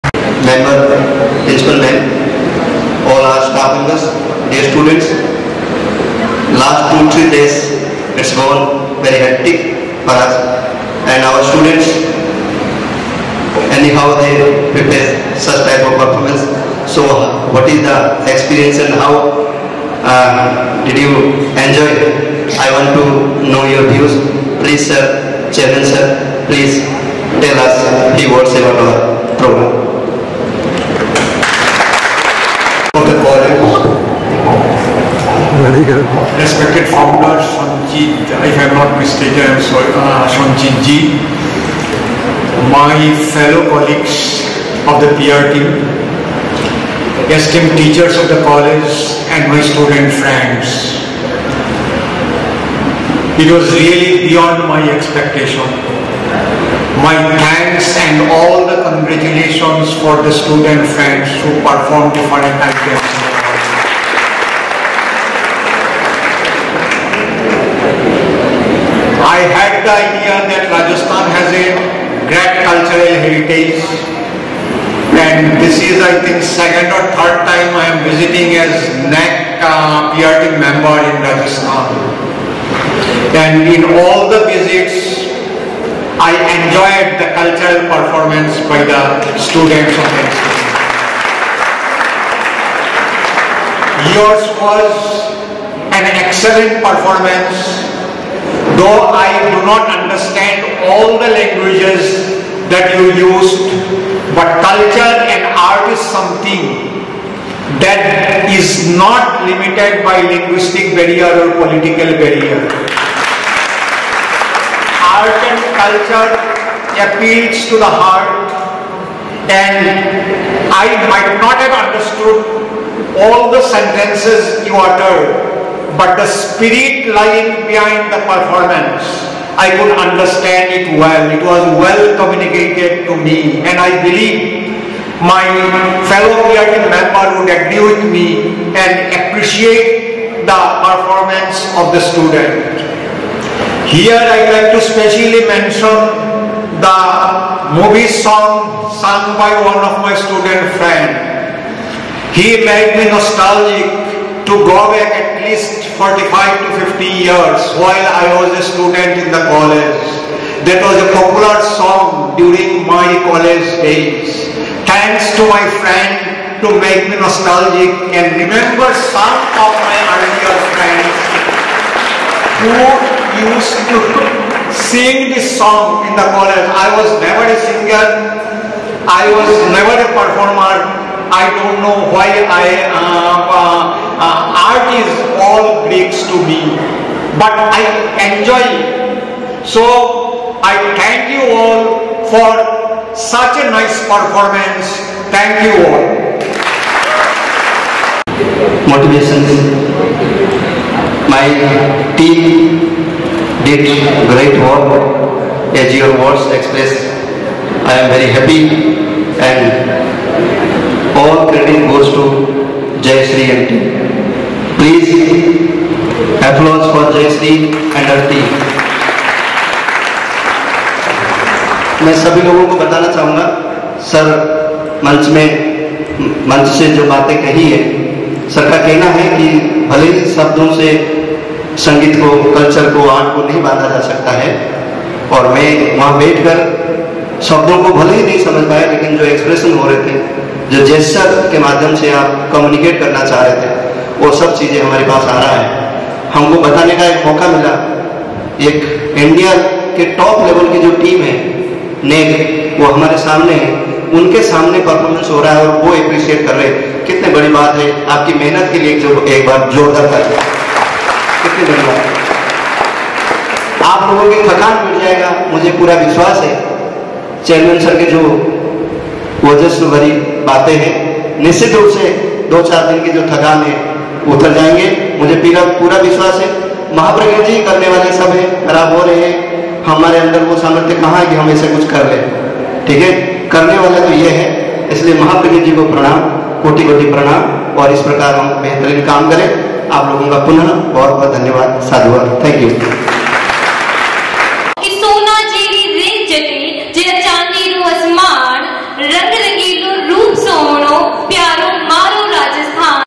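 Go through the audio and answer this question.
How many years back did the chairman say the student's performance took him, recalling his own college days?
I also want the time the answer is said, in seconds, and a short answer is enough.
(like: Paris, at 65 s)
45 to 50, at 155 s.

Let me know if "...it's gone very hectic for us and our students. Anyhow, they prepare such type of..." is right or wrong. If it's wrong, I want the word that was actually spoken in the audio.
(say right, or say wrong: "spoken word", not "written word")
right.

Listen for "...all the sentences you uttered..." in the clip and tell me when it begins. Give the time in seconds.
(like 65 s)
123 s.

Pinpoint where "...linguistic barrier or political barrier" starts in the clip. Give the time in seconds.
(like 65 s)
110 s.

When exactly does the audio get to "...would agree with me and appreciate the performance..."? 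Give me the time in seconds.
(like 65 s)
137 s.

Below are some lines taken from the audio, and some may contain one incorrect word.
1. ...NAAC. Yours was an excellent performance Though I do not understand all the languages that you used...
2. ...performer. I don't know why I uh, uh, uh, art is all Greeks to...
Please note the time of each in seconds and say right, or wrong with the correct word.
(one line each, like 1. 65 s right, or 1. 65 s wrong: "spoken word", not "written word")
1. 90 s right
2. 180 s right.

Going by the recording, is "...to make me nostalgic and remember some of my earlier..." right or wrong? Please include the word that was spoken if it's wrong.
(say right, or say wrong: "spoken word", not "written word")
right.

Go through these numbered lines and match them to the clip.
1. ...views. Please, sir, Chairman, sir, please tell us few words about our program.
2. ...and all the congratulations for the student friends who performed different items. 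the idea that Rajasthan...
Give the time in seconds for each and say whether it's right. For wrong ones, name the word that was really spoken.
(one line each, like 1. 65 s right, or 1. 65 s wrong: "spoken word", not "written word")
1. 23 s right
2. 58 s right.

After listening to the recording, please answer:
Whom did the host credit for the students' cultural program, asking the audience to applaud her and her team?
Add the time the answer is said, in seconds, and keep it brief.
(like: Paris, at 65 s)
Jayshree, at 217 s.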